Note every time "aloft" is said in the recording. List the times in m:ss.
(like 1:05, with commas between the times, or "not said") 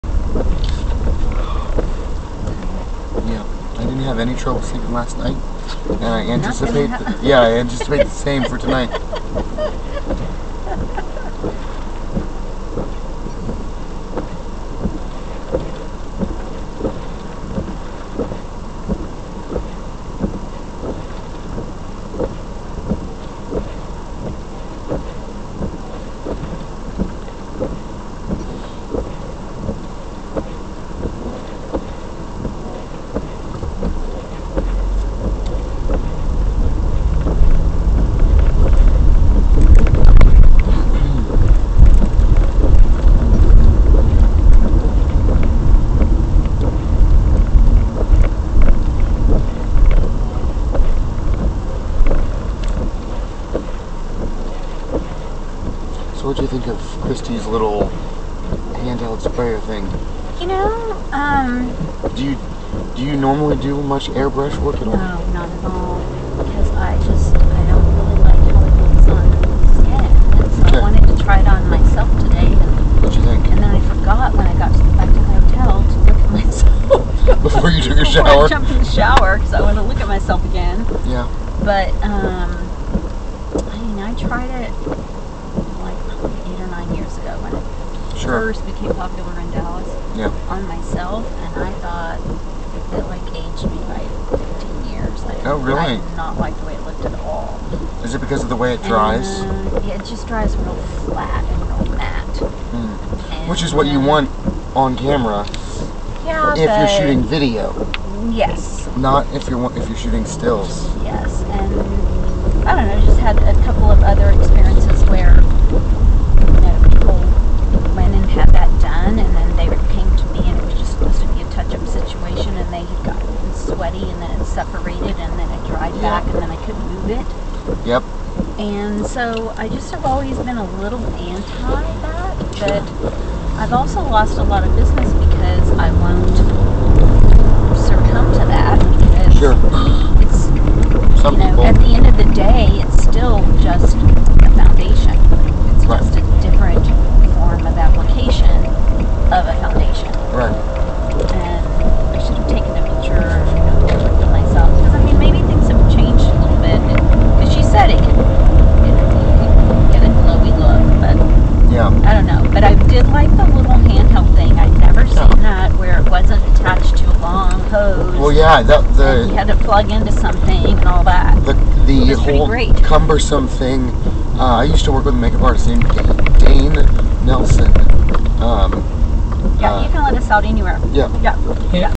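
not said.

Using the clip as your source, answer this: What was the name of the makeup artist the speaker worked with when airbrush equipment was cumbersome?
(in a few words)
Dane Nelson.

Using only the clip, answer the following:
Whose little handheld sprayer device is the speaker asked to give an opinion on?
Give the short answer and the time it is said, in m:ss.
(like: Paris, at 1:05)
Christie, at 0:57.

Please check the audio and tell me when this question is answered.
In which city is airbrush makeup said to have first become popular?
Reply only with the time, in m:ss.
1:29.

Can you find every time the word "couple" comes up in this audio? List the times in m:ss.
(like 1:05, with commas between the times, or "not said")
1:53.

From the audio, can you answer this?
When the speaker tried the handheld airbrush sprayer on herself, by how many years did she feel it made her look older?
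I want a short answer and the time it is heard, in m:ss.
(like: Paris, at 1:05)
15, at 1:34.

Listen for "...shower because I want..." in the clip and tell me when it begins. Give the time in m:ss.
1:18.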